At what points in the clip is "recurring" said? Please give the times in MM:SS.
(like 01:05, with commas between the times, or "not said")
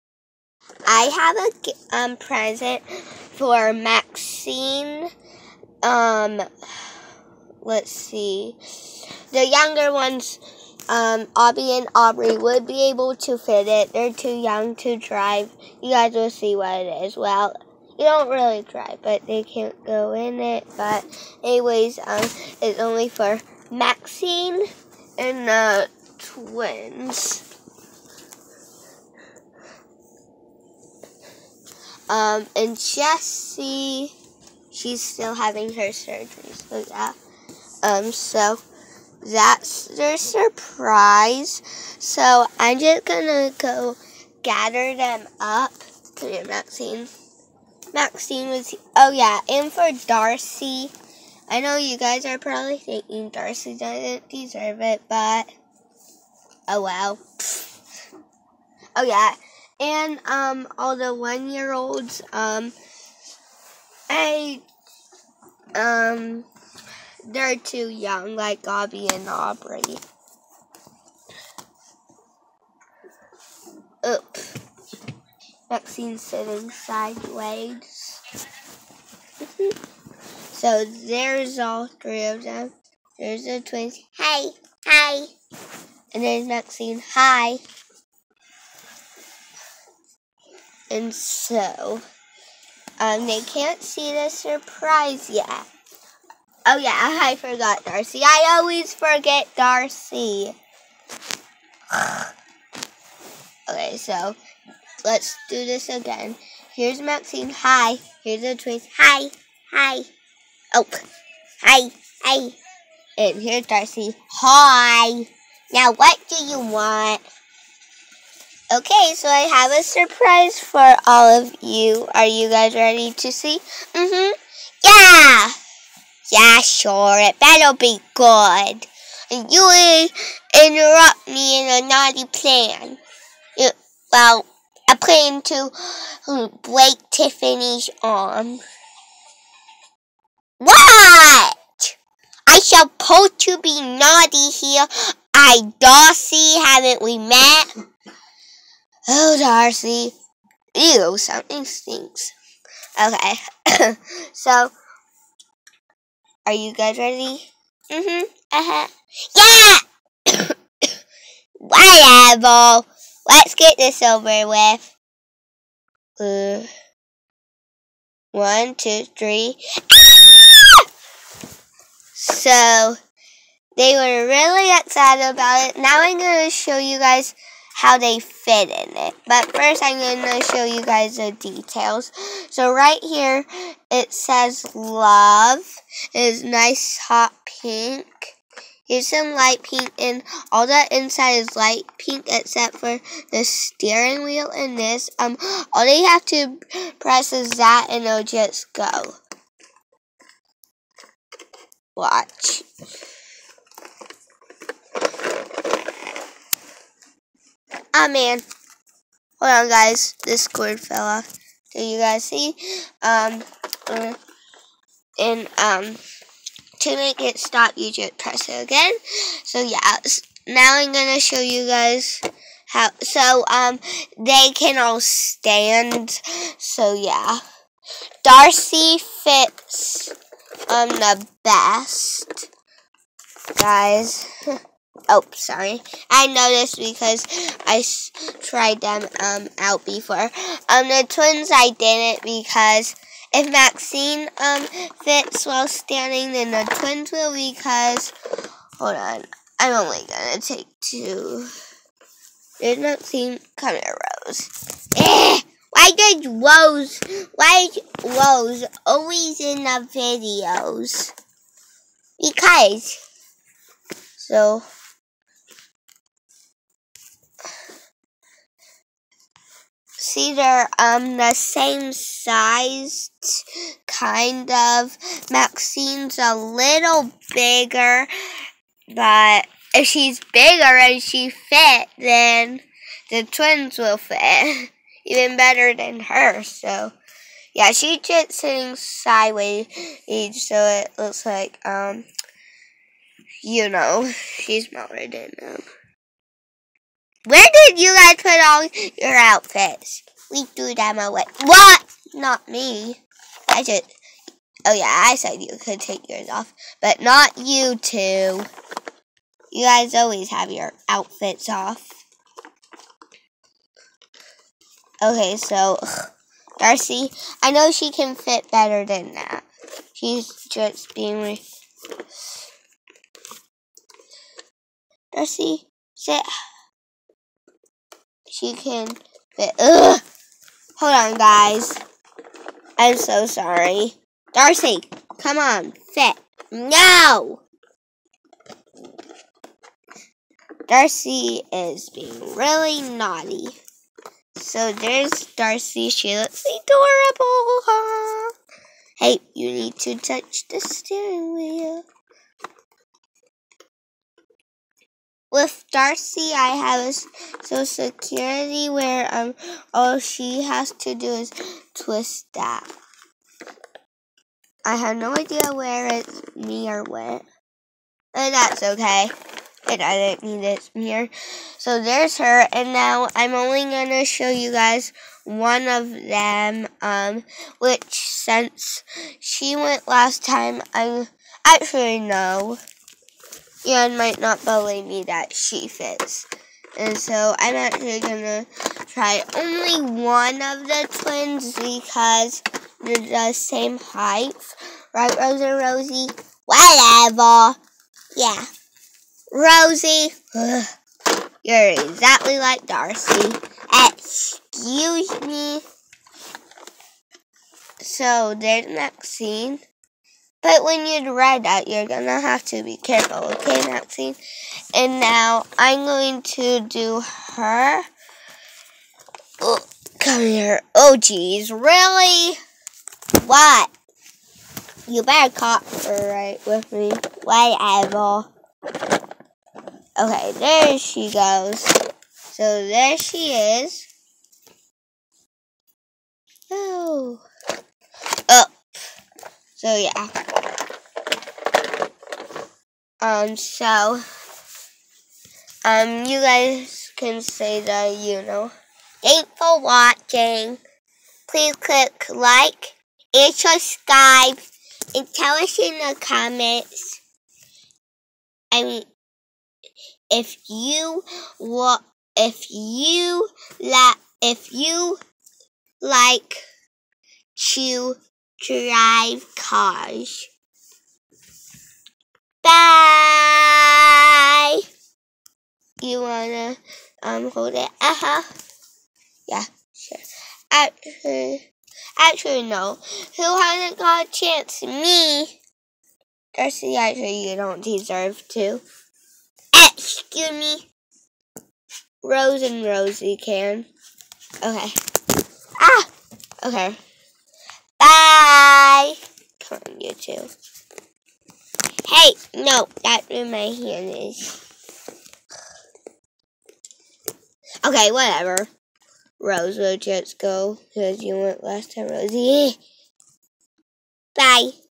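not said.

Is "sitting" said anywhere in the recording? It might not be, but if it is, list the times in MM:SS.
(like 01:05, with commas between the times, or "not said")
01:16, 04:48.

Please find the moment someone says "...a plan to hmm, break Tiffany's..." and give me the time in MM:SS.
02:14.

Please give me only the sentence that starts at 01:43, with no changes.
okay, so let's do this again.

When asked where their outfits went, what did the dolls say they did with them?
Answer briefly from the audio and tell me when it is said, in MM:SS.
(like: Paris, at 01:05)
threw them away, at 05:00.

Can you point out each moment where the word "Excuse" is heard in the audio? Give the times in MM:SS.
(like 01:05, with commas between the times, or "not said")
06:43, 08:09.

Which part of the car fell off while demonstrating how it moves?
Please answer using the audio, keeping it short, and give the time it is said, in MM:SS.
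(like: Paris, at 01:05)
cord, at 03:30.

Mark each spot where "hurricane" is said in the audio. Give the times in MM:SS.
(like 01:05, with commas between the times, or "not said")
not said.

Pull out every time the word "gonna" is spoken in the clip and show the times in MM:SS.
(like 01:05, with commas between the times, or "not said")
00:43, 04:10, 06:13, 06:27, 06:51.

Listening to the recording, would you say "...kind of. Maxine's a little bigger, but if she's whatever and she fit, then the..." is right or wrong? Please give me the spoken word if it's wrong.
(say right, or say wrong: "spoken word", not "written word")
wrong: "bigger", not "whatever".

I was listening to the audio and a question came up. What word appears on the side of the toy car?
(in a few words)
love.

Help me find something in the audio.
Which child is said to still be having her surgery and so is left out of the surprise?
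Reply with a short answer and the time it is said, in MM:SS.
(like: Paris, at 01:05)
Jessie, at 00:32.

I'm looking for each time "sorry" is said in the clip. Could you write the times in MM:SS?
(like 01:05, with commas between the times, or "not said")
03:55, 05:33.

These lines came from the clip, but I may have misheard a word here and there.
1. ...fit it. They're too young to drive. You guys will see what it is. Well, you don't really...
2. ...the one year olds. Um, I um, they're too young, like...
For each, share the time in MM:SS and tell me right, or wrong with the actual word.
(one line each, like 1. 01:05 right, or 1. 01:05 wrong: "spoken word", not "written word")
1. 00:13 right
2. 01:00 right.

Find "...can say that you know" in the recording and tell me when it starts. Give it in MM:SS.
07:26.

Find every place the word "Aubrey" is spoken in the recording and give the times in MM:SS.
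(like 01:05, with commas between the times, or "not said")
00:11, 01:09.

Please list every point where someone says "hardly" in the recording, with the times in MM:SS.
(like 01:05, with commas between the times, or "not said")
not said.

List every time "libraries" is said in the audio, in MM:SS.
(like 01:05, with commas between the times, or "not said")
not said.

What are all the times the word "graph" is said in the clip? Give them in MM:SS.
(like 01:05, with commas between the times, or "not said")
not said.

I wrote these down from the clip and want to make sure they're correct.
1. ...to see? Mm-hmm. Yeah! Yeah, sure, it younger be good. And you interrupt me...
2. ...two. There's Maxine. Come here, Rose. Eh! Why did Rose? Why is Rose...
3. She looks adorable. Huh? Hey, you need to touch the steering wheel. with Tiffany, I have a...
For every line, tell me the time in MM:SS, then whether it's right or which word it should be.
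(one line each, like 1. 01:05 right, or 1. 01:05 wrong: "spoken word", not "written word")
1. 02:03 wrong: "better", not "younger"
2. 04:10 right
3. 05:45 wrong: "Darcy", not "Tiffany".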